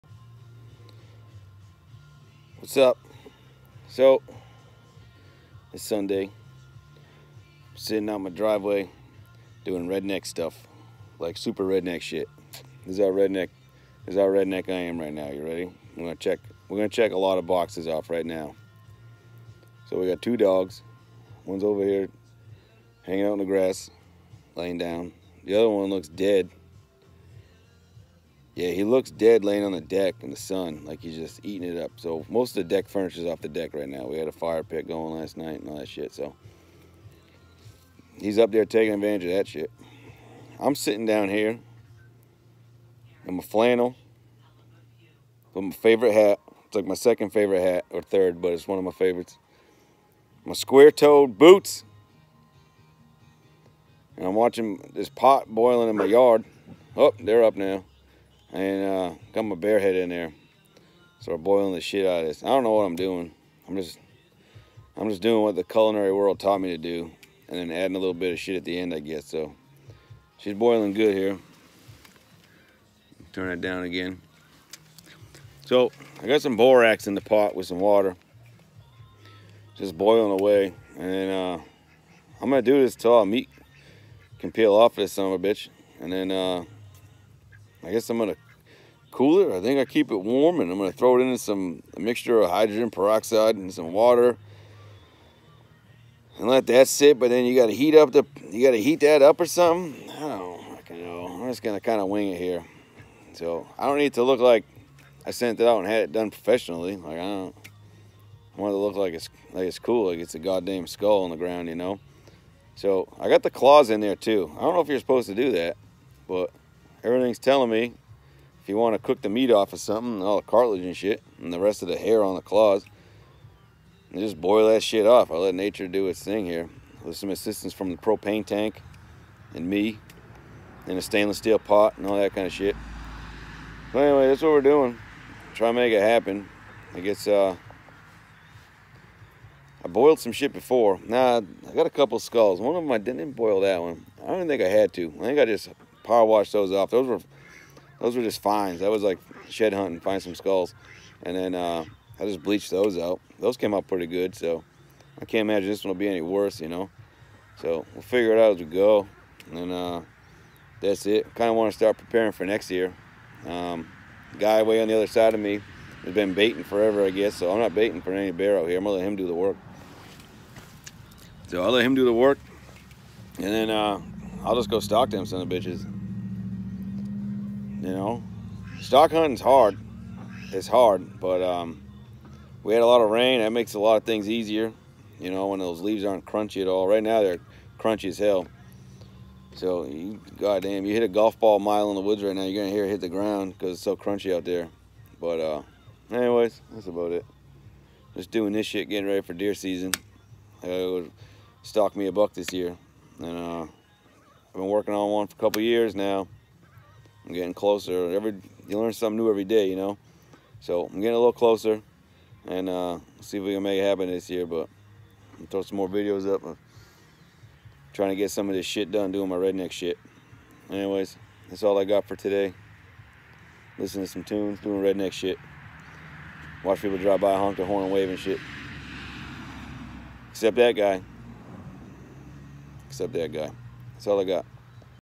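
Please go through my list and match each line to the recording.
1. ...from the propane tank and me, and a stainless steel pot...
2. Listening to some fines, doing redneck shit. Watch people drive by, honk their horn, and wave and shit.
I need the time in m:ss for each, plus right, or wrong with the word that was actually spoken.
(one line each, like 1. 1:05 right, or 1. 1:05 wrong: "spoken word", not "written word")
1. 2:07 right
2. 3:43 wrong: "tunes", not "fines".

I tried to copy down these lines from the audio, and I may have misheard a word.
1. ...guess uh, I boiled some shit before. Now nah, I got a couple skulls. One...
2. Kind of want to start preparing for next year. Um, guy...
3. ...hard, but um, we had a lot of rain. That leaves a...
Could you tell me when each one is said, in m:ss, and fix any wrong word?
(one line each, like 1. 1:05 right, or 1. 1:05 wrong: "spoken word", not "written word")
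1. 2:16 right
2. 2:41 right
3. 3:00 wrong: "makes", not "leaves".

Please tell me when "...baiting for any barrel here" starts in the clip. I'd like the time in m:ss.
2:47.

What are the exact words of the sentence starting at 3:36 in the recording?
I'm trying to get some of this shit done, doing my redneck shit.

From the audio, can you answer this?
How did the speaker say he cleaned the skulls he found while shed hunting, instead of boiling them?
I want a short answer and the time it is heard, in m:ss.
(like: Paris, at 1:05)
power washed, at 2:26.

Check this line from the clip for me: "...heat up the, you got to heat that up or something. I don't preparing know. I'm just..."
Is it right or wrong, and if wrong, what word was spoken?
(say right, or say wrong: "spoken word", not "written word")
wrong: "fucking", not "preparing".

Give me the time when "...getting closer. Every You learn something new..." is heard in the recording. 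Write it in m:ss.
3:27.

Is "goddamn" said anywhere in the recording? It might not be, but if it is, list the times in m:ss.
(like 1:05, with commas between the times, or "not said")
1:50, 3:10.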